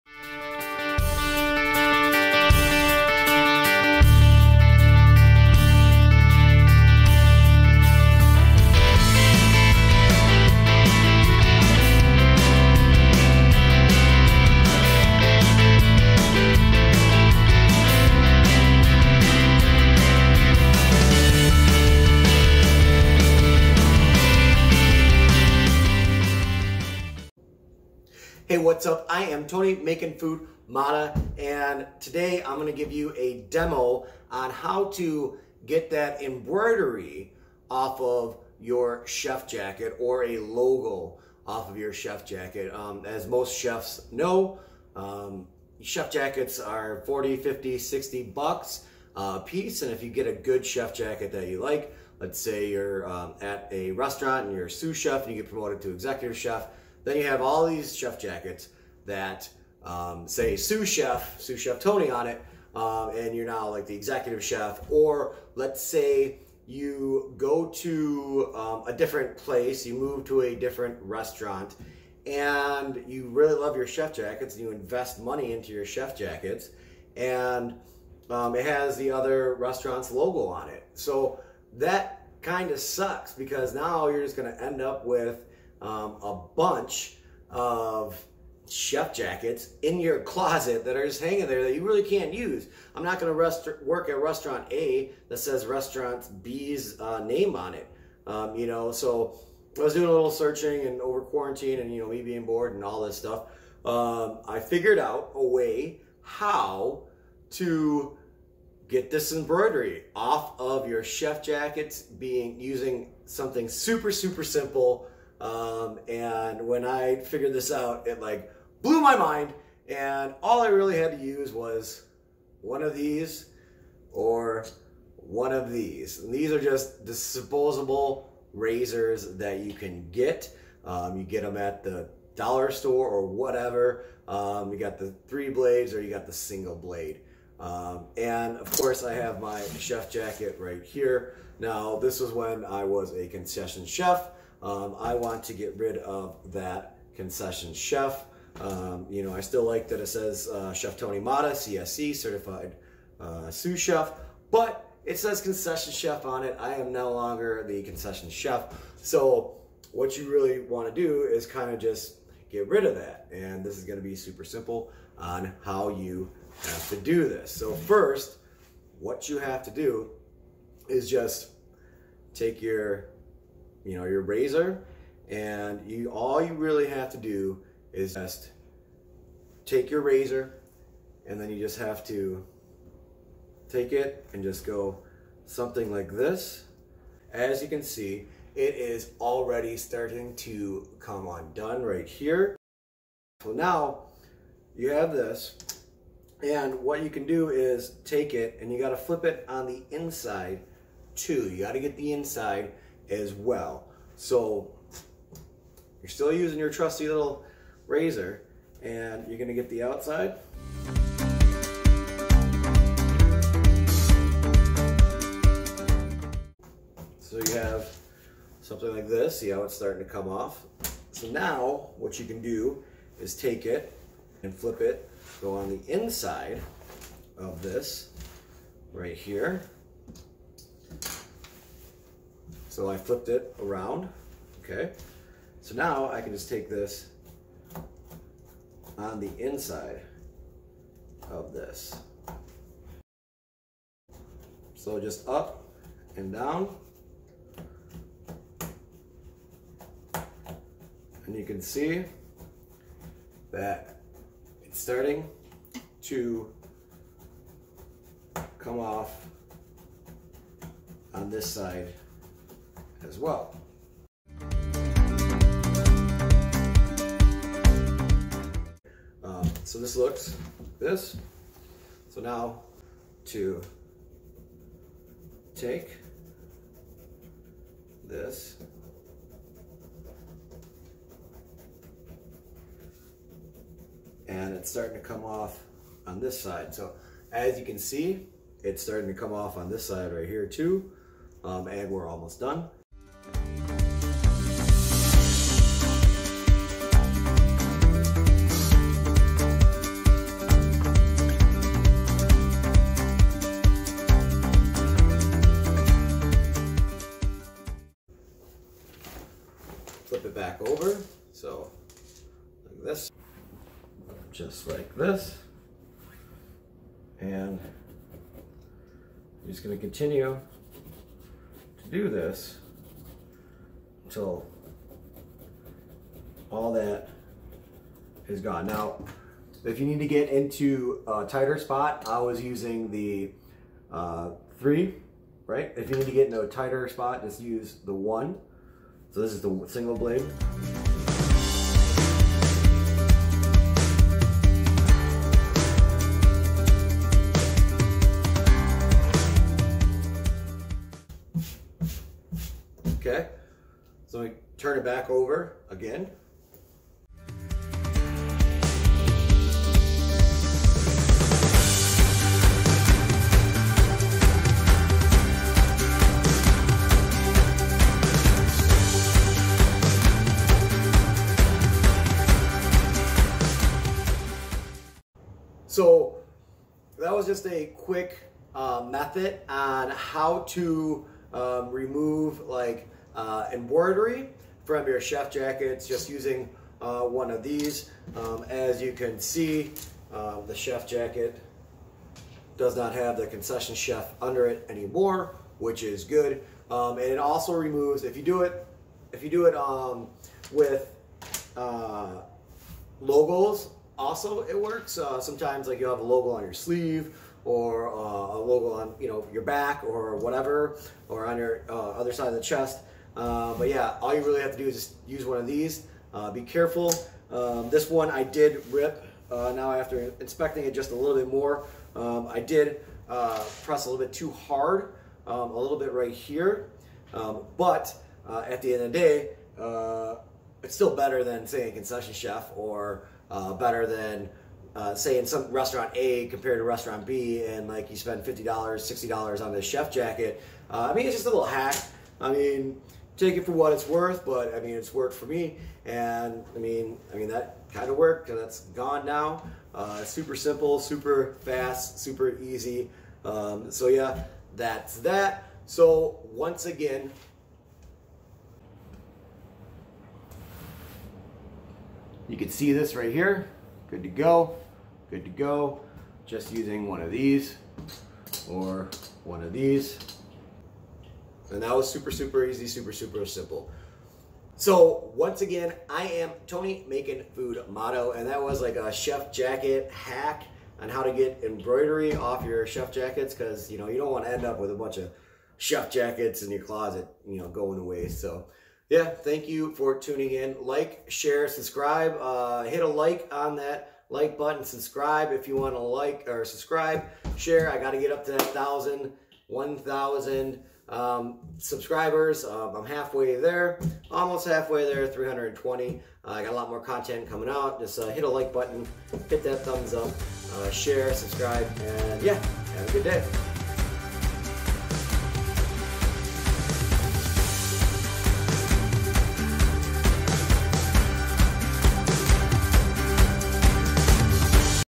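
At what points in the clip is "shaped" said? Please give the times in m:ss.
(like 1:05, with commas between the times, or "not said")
not said.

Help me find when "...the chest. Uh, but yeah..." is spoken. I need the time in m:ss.
6:52.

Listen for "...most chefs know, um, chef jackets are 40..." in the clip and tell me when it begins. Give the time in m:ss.
0:43.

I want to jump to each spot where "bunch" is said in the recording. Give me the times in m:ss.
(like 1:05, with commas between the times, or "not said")
1:26, 8:04.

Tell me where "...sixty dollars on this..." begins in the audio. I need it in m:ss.
7:18.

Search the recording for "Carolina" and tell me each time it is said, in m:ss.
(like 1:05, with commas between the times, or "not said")
not said.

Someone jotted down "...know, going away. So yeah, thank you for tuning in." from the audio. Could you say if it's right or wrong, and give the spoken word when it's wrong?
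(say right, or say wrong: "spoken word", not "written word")
right.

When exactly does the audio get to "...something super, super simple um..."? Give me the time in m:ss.
1:53.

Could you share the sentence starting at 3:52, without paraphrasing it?
So I flipped it around, okay?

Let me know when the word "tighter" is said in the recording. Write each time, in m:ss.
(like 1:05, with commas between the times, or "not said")
5:31, 5:36.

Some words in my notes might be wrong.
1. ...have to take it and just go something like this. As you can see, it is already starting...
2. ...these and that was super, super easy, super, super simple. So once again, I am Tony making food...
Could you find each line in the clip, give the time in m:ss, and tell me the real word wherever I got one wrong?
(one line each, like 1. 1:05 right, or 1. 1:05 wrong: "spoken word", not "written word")
1. 3:01 right
2. 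7:49 right.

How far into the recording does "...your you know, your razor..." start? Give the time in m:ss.
2:52.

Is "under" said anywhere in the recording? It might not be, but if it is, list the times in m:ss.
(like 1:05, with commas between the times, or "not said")
6:34.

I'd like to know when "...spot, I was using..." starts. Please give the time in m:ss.
5:31.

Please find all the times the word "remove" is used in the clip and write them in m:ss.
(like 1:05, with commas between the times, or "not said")
6:21, 6:37.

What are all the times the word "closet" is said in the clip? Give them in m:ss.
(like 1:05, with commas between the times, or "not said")
1:30, 8:06.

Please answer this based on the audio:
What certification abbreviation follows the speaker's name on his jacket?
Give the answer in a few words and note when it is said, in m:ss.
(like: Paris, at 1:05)
CSC, at 2:31.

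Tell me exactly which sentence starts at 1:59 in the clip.
And all I really had to use was one of these or one of these.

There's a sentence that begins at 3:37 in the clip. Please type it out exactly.
So you have something like this, see how it's starting to come off.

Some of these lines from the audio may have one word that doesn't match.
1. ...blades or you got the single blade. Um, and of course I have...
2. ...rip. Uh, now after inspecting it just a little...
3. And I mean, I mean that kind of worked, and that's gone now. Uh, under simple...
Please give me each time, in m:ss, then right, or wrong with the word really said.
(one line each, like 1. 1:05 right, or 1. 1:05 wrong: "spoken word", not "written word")
1. 2:15 right
2. 6:58 right
3. 7:25 wrong: "super", not "under".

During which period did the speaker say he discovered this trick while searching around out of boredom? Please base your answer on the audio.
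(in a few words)
Quarantine.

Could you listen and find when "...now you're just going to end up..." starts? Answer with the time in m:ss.
1:23.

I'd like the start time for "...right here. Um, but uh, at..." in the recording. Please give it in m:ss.
7:05.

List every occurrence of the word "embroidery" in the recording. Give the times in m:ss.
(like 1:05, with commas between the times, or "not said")
0:36, 1:49, 6:23, 8:01.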